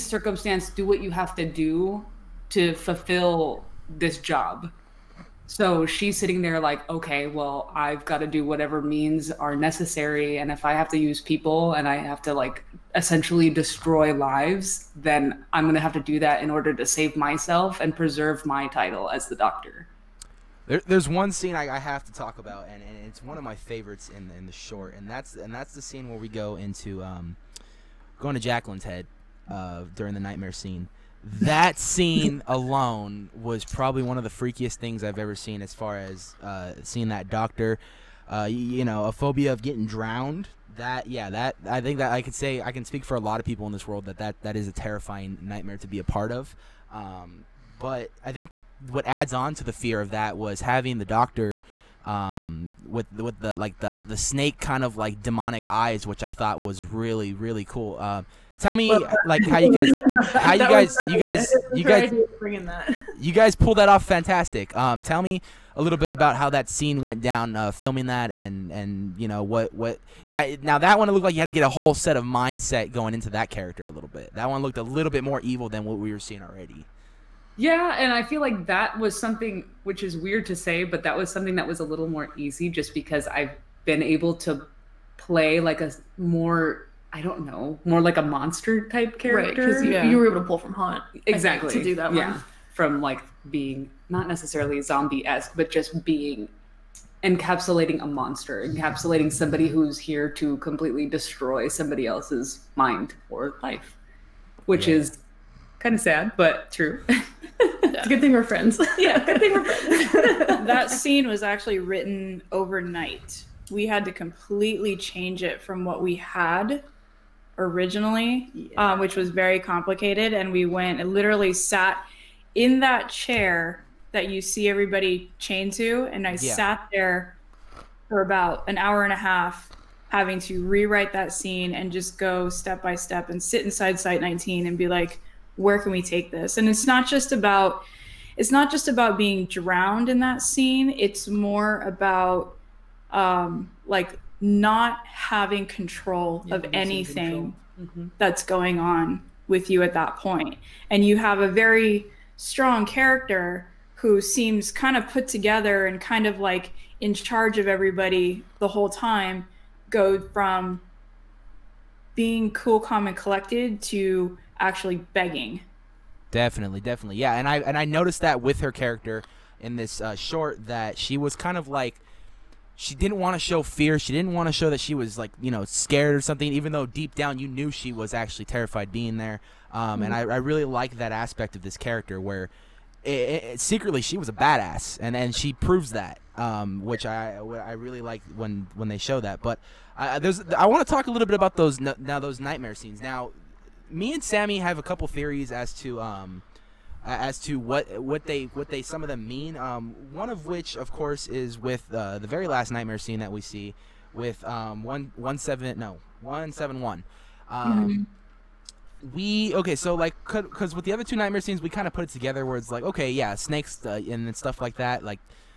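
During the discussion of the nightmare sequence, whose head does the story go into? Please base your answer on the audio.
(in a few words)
Jacqueline.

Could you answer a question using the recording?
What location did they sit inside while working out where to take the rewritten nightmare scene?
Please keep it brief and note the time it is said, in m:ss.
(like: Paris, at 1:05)
Site 19, at 2:13.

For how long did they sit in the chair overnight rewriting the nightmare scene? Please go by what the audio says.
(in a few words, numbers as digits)
An hour and a half.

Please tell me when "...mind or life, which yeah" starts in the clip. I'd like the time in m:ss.
1:42.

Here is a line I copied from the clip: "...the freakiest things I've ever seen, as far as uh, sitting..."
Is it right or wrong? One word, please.
wrong.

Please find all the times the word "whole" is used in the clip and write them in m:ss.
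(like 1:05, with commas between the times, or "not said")
1:11, 2:38.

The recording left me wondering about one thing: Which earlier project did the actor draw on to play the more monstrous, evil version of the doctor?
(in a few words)
Haunt.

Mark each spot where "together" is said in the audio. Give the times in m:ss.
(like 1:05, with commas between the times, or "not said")
2:35, 3:32.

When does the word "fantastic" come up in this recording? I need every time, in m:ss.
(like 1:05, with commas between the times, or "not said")
1:04.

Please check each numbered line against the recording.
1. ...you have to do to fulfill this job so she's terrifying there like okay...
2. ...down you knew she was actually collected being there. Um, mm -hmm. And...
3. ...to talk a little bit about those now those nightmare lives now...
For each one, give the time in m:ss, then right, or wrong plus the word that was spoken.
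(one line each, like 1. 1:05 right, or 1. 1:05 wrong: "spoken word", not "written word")
1. 0:01 wrong: "sitting", not "terrifying"
2. 2:57 wrong: "terrified", not "collected"
3. 3:10 wrong: "scenes", not "lives".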